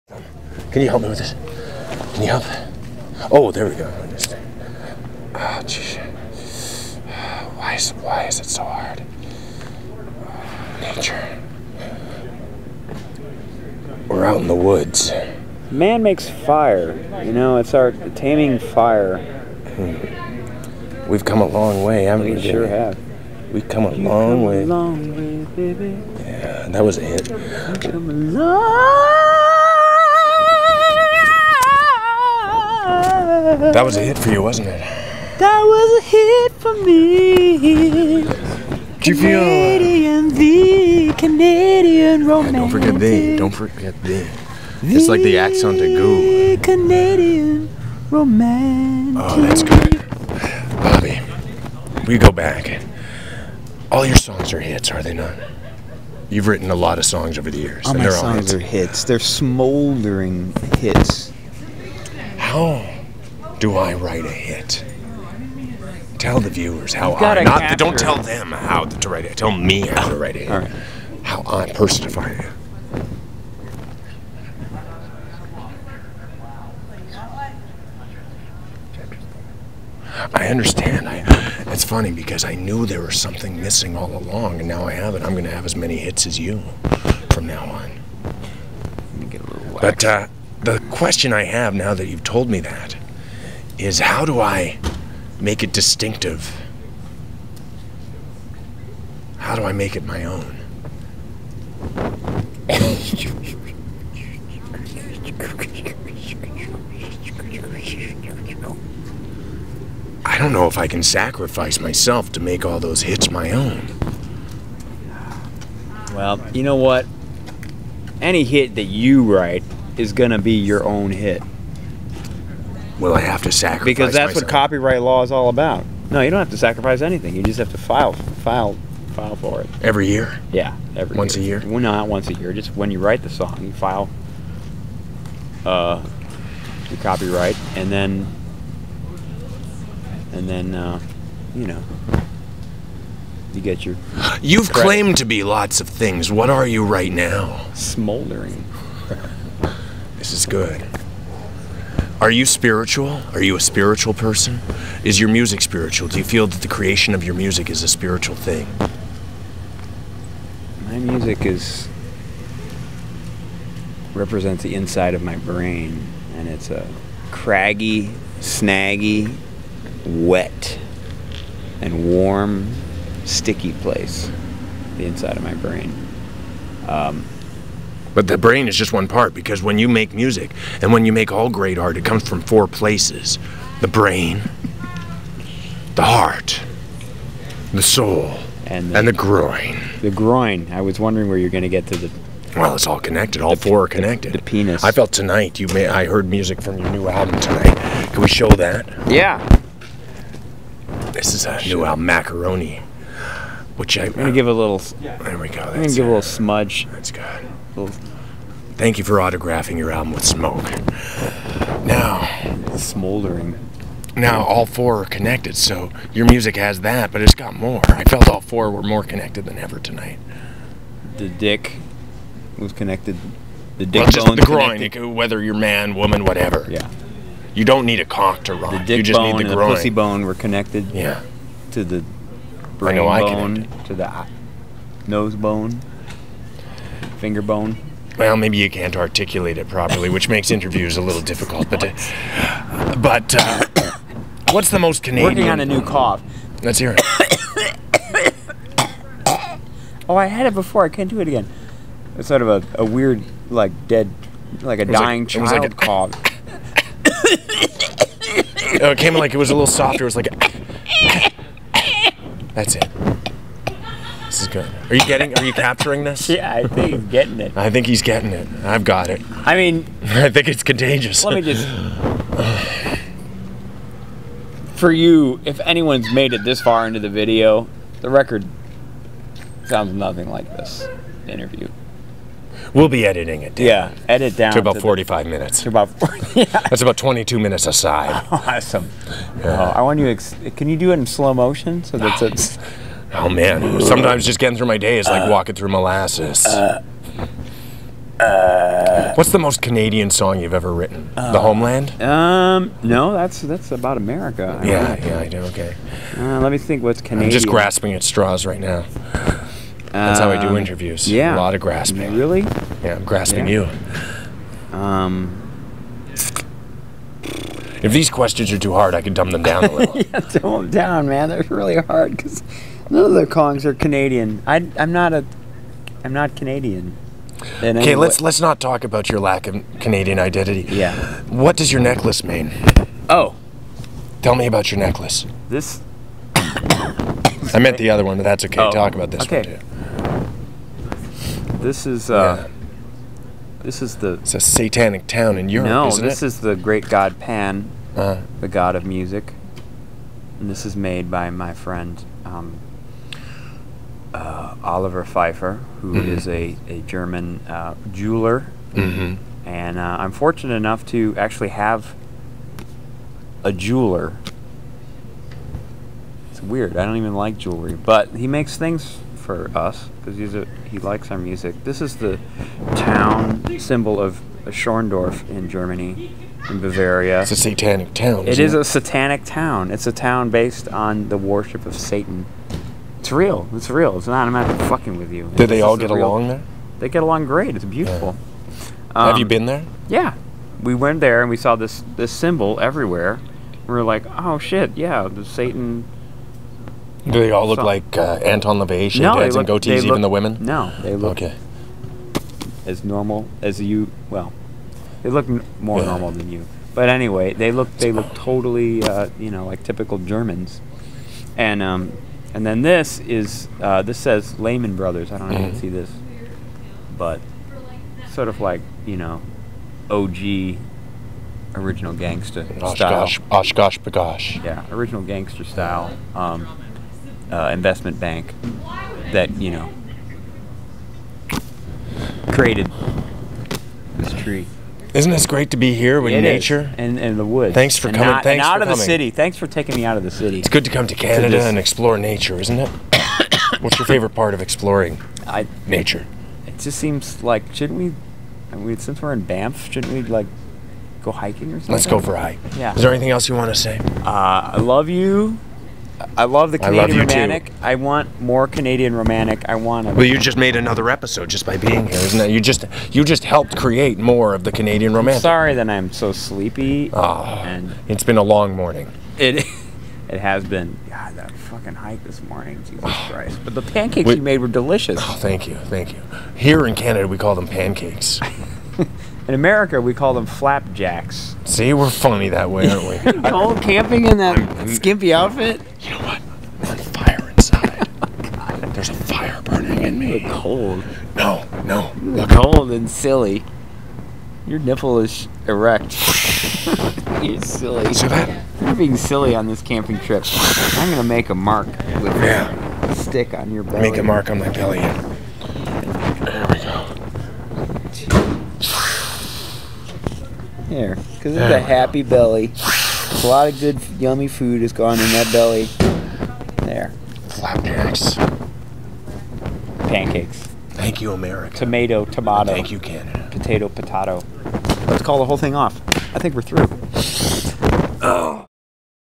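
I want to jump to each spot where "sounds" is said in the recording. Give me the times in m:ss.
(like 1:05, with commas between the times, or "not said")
4:39.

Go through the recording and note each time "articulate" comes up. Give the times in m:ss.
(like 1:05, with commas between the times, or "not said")
3:58.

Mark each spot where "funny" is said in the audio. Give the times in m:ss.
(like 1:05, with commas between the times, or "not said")
1:21, 8:01.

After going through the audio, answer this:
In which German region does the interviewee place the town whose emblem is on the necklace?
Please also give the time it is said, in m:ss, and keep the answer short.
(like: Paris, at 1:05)
Bavaria, at 6:16.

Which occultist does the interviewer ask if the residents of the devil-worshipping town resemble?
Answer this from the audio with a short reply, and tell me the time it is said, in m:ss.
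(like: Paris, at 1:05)
Anton LaVey, at 6:38.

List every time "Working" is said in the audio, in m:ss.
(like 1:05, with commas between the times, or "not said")
4:05.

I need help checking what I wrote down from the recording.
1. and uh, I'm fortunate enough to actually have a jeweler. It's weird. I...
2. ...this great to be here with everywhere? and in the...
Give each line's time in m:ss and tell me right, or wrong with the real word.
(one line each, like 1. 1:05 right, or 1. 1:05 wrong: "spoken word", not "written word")
1. 5:59 right
2. 7:15 wrong: "nature", not "everywhere".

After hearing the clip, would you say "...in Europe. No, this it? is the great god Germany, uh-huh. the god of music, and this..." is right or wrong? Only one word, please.
wrong.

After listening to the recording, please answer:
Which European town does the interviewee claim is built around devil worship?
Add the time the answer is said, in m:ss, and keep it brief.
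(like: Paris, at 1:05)
Schorndorf, at 6:14.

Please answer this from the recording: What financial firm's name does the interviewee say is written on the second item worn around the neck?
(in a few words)
Lehman Brothers.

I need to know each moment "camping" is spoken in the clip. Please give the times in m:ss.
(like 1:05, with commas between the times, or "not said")
8:03, 8:19.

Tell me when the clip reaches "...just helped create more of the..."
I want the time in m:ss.
7:43.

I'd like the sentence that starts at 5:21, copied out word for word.
They're really hard because none of the Kongs are Canadian.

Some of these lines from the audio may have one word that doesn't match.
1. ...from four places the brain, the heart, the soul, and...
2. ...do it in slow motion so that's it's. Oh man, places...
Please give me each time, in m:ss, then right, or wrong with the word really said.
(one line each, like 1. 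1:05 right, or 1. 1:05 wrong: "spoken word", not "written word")
1. 3:02 right
2. 4:50 wrong: "sometimes", not "places".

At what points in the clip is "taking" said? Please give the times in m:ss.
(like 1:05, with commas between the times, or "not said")
7:19.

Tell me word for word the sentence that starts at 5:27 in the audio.
Okay, let's let's not talk about your lack of Canadian identity.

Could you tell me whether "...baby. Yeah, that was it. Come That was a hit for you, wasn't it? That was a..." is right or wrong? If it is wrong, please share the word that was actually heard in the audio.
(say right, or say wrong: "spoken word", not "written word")
right.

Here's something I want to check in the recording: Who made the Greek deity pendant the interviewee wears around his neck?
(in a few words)
Oliver Pfeiffer.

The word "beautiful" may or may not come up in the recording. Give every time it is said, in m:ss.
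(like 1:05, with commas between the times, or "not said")
6:27.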